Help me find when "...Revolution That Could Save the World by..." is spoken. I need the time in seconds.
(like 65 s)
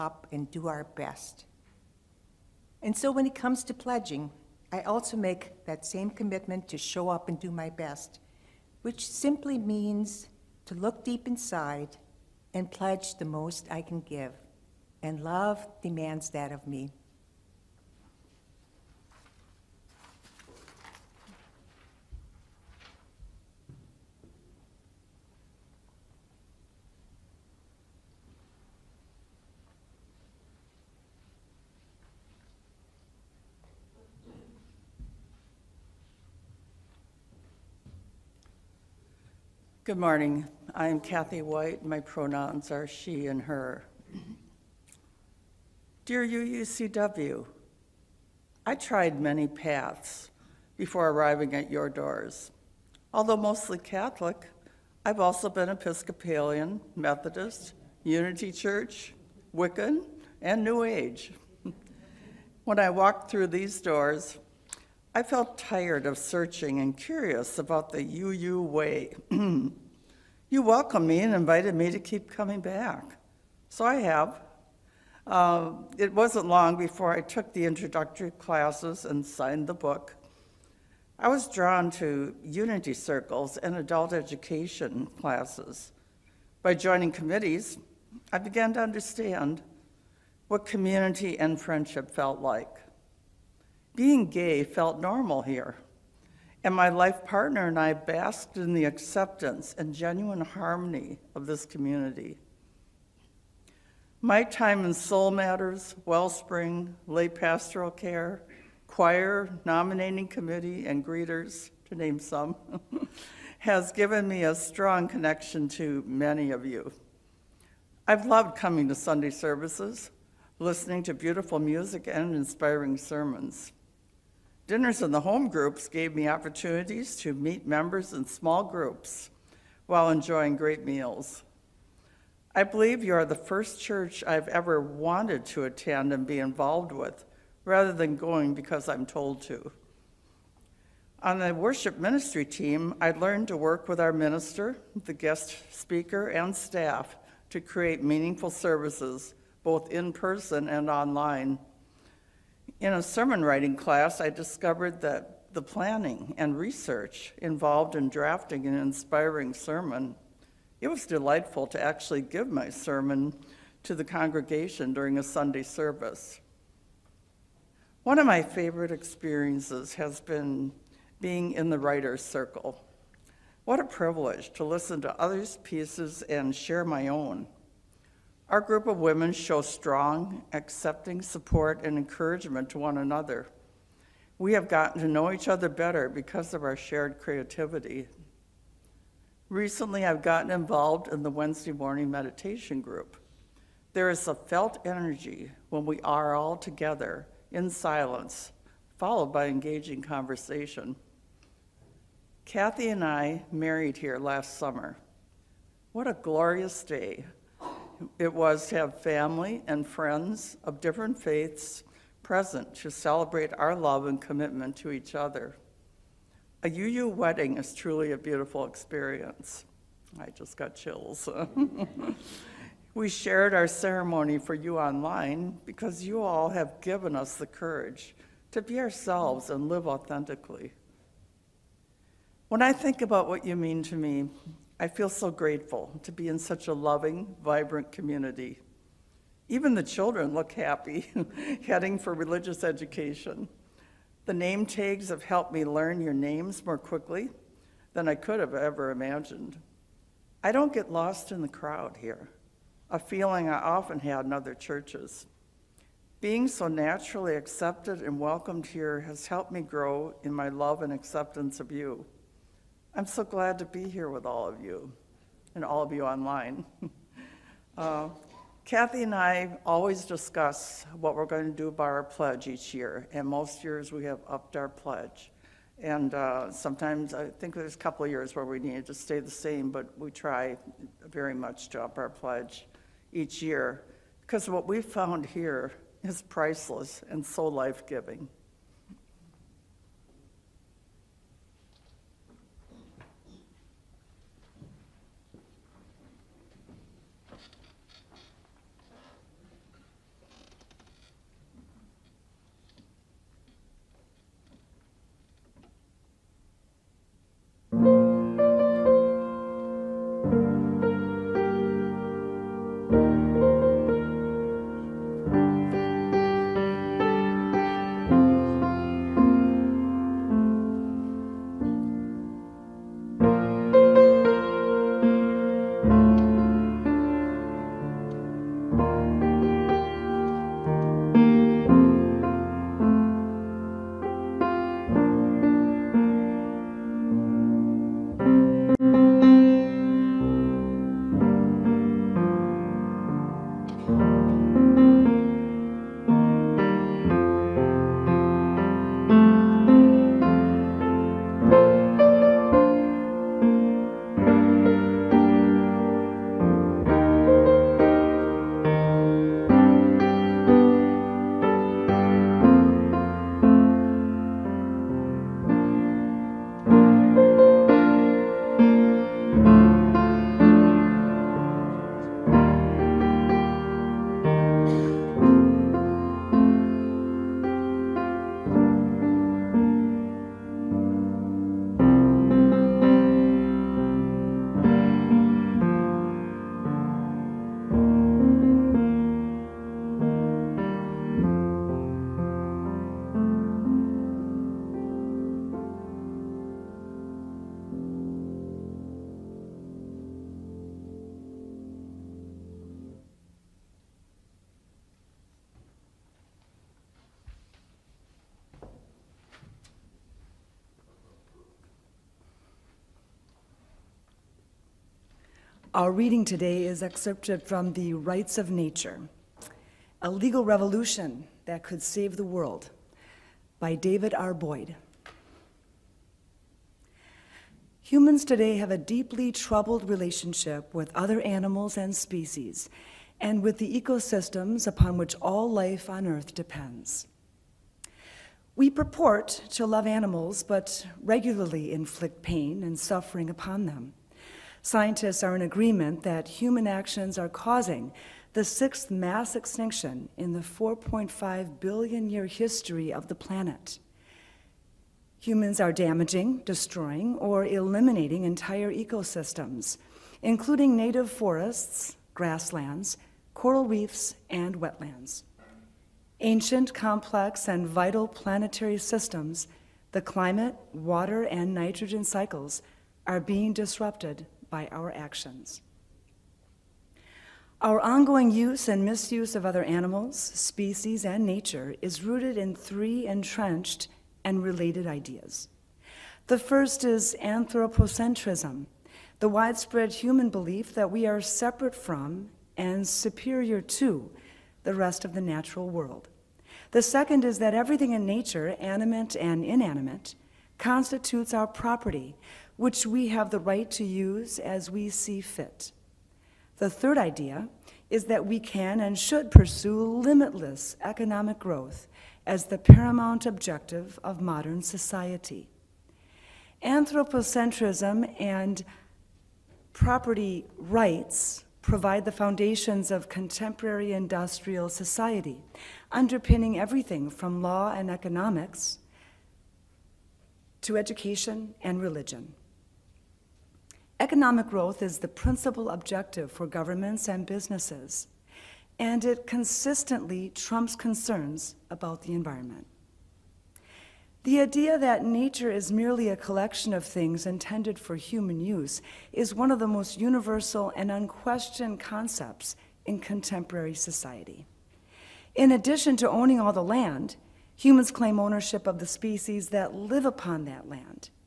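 420 s.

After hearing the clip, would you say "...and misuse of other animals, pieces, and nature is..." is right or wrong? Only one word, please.
wrong.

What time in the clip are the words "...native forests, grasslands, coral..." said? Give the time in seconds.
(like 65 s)
460 s.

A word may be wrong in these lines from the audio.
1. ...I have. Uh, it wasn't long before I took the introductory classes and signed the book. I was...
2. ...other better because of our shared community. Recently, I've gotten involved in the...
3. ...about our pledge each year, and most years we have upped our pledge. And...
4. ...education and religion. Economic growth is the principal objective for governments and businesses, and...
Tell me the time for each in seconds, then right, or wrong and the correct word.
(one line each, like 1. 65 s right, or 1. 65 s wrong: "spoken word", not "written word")
1. 73 s right
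2. 185 s wrong: "creativity", not "community"
3. 271 s right
4. 530 s right.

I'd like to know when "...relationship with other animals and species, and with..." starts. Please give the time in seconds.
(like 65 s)
429 s.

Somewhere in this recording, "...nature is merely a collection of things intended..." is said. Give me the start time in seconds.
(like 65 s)
545 s.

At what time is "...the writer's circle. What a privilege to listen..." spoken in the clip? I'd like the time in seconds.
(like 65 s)
171 s.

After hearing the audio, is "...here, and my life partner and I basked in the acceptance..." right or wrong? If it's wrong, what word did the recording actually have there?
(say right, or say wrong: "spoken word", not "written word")
right.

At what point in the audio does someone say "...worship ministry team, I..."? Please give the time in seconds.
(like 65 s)
141 s.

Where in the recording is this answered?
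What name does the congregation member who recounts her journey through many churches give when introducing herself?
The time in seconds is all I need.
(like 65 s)
40 s.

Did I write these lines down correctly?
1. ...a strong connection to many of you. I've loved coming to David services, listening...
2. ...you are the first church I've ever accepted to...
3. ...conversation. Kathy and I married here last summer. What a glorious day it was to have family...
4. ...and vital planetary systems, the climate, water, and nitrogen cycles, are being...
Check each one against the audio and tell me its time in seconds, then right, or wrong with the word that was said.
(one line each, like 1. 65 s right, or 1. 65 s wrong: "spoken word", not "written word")
1. 114 s wrong: "Sunday", not "David"
2. 133 s wrong: "wanted", not "accepted"
3. 199 s right
4. 467 s right.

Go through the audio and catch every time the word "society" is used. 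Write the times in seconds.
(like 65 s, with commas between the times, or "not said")
514 s, 524 s, 553 s.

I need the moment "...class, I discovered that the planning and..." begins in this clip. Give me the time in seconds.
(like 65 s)
153 s.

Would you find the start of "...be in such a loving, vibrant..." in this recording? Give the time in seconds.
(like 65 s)
236 s.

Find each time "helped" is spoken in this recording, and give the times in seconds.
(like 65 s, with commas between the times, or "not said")
245 s, 259 s.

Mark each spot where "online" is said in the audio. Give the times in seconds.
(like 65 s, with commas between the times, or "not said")
150 s, 224 s, 266 s.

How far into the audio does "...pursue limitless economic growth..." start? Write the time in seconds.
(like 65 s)
509 s.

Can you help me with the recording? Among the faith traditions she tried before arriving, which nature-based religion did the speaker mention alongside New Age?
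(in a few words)
Wiccan.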